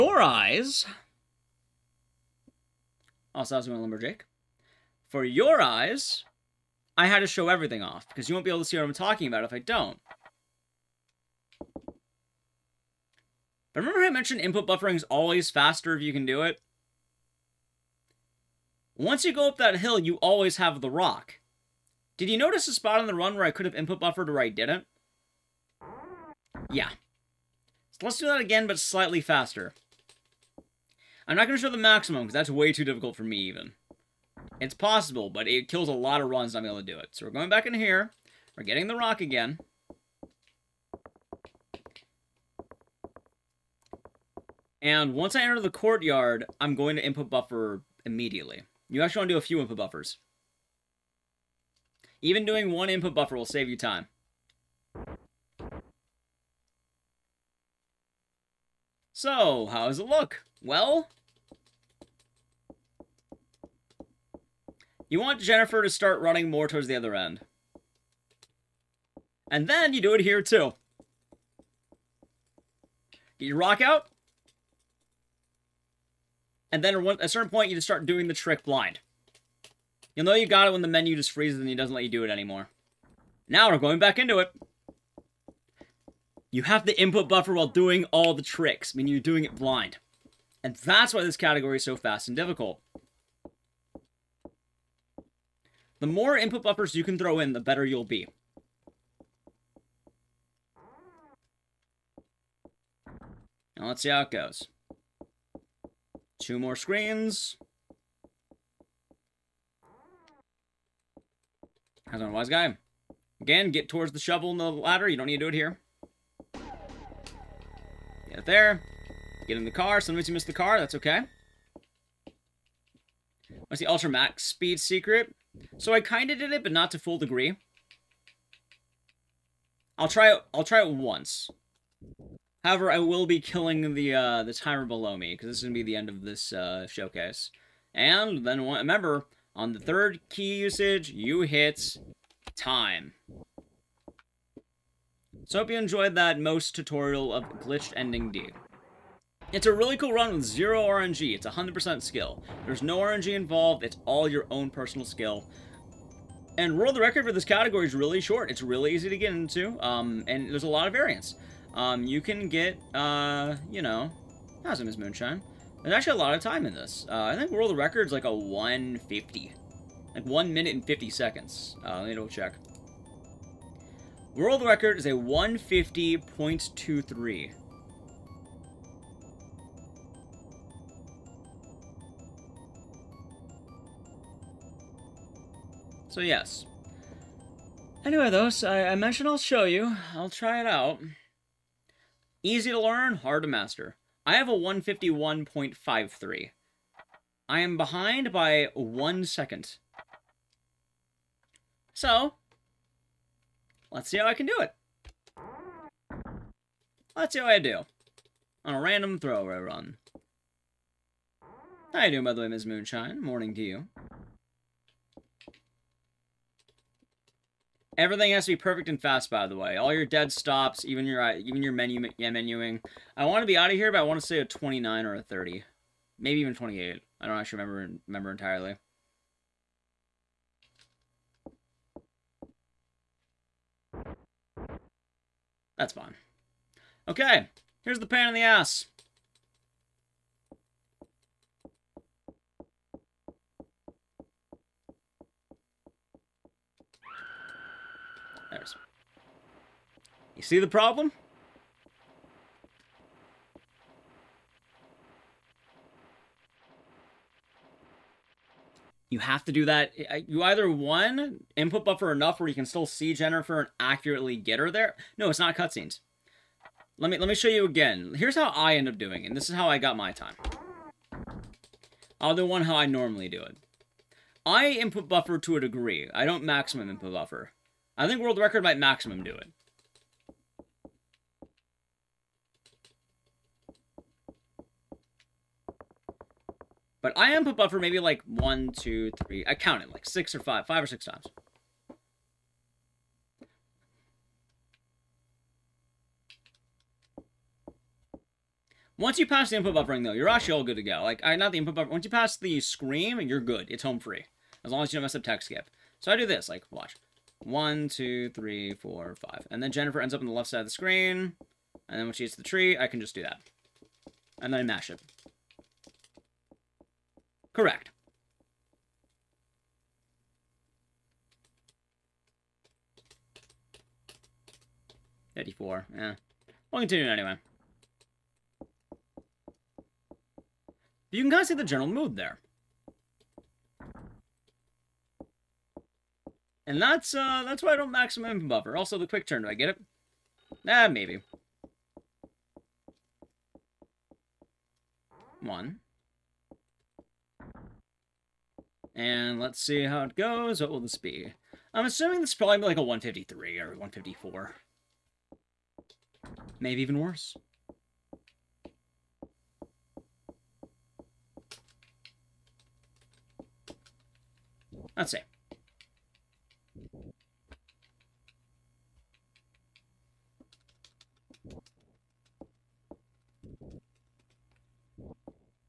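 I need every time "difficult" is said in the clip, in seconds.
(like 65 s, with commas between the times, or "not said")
32 s, 92 s.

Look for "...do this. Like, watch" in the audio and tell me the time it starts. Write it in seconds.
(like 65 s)
306 s.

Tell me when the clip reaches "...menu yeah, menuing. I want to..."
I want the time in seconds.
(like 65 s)
221 s.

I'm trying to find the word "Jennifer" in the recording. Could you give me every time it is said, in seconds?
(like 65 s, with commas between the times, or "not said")
65 s, 263 s, 309 s.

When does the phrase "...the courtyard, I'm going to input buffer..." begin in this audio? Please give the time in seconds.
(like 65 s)
45 s.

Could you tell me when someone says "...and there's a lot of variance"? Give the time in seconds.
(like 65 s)
160 s.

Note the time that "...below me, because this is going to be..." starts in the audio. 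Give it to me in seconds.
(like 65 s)
134 s.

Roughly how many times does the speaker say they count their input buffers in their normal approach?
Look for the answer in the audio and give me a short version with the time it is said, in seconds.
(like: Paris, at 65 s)
5 or 6, at 290 s.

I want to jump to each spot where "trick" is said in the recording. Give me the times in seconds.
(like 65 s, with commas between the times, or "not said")
78 s, 88 s.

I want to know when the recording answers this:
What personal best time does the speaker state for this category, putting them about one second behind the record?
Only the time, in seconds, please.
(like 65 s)
194 s.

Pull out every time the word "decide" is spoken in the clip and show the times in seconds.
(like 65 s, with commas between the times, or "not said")
not said.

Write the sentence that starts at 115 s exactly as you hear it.
You don't need to do it here.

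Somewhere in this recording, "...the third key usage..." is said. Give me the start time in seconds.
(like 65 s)
139 s.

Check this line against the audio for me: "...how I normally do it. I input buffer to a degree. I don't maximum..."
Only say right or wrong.
right.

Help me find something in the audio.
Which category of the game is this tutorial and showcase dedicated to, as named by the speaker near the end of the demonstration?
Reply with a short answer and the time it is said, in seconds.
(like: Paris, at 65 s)
Glitched Ending D, at 147 s.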